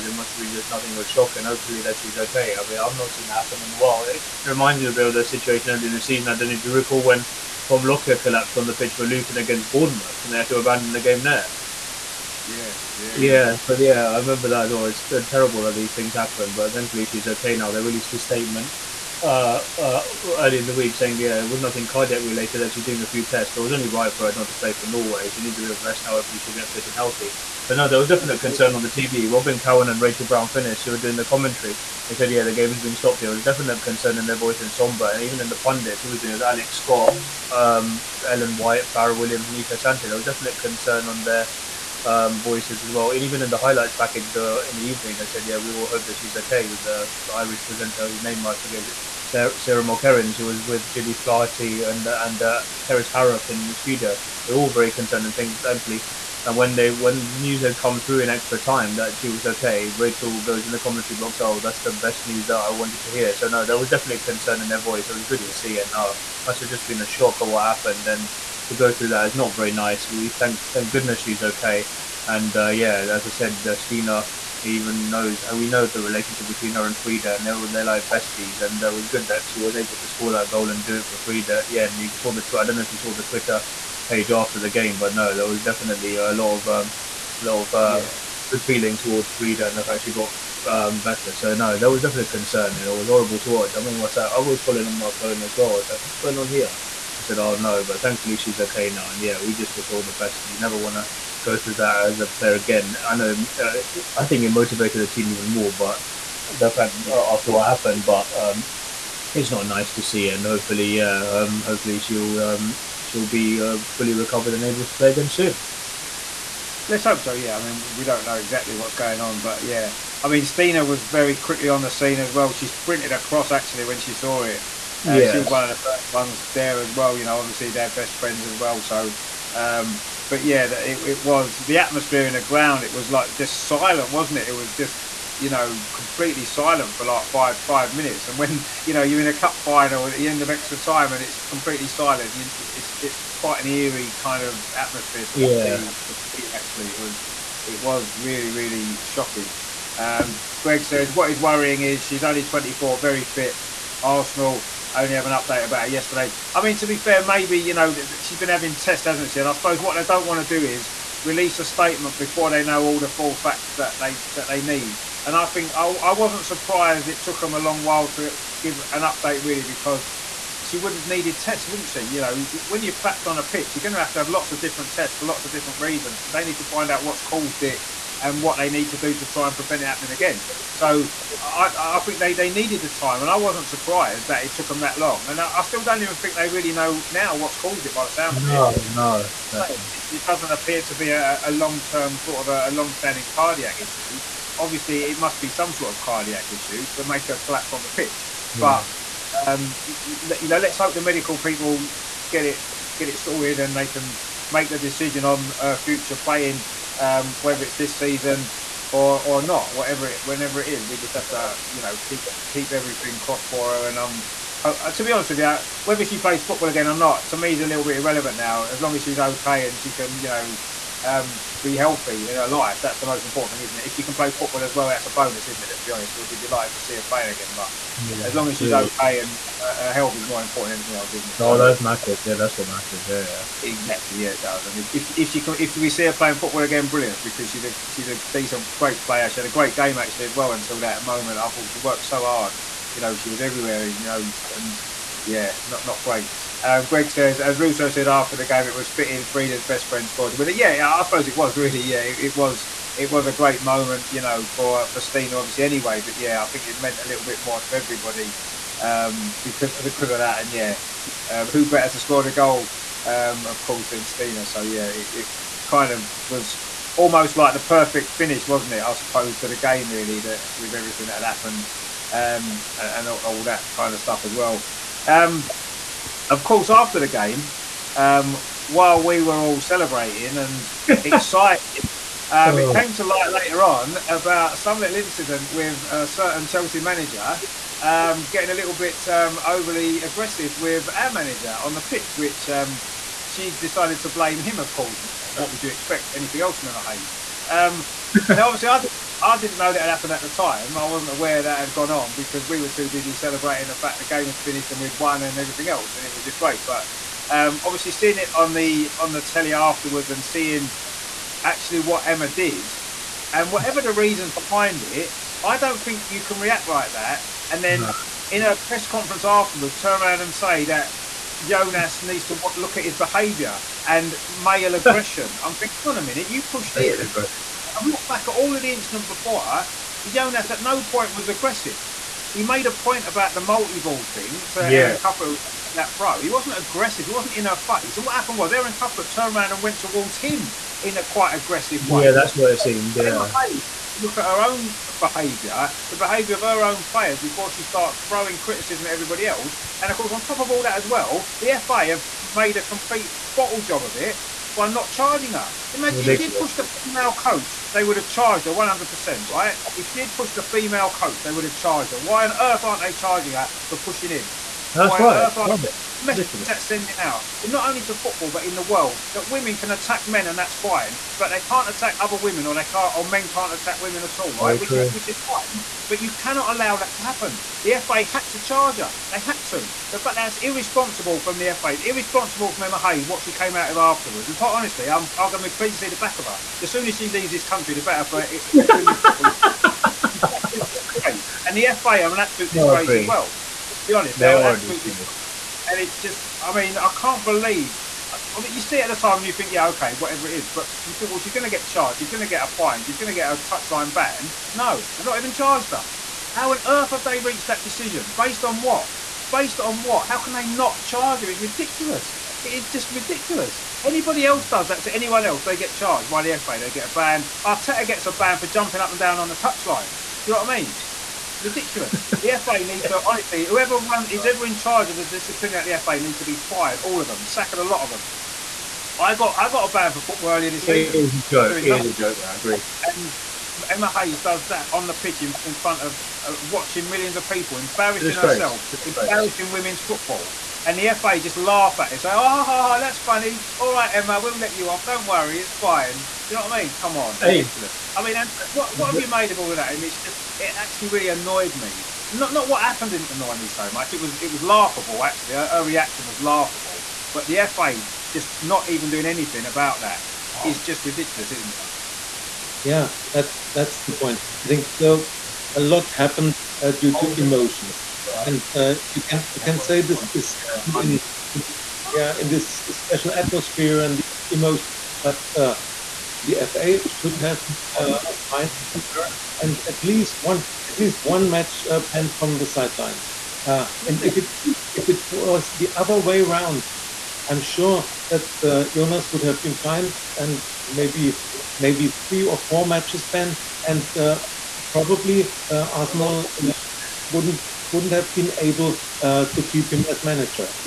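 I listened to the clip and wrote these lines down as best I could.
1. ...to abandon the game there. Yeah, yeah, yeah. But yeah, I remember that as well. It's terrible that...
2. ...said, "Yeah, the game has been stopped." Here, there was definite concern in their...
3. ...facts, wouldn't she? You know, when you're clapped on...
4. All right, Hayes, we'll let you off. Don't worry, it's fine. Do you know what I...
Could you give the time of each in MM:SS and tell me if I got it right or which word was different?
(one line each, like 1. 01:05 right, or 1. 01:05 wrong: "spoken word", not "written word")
1. 00:10 right
2. 00:32 right
3. 02:51 wrong: "tests", not "facts"
4. 07:23 wrong: "Emma", not "Hayes".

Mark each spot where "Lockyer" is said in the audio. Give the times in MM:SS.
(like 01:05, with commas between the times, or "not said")
00:07.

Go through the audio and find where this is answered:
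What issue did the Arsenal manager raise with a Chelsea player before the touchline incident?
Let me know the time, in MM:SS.
05:33.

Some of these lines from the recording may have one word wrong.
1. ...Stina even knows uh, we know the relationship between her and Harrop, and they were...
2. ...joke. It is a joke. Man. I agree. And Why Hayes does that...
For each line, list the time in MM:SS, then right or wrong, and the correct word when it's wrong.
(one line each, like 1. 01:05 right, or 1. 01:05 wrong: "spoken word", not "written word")
1. 01:13 wrong: "Frida", not "Harrop"
2. 07:11 wrong: "Emma", not "Why".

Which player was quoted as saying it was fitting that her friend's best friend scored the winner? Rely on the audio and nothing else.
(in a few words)
Russo.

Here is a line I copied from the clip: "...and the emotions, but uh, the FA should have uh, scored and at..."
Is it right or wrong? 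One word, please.
wrong.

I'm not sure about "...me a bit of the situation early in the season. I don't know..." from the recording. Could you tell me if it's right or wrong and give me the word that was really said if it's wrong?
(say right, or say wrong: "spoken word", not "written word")
right.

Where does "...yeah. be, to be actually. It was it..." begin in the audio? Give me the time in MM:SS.
02:25.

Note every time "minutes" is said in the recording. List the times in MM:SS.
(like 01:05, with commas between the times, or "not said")
02:17, 05:26.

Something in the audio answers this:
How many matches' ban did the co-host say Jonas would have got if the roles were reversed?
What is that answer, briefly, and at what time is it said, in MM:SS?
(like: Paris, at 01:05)
3 or 4, at 08:11.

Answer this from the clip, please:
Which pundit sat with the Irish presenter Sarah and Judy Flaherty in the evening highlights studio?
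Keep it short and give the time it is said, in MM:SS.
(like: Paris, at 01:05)
Kerys Harrop, at 00:52.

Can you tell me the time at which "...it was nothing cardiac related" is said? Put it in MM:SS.
00:21.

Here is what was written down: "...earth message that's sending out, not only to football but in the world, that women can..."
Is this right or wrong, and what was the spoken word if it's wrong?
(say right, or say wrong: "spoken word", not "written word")
right.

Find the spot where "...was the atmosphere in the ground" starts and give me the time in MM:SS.
02:11.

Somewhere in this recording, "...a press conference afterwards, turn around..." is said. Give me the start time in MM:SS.
05:18.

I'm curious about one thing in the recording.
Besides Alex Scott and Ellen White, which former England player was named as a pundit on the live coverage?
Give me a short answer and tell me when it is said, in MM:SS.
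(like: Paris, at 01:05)
Fara Williams, at 00:38.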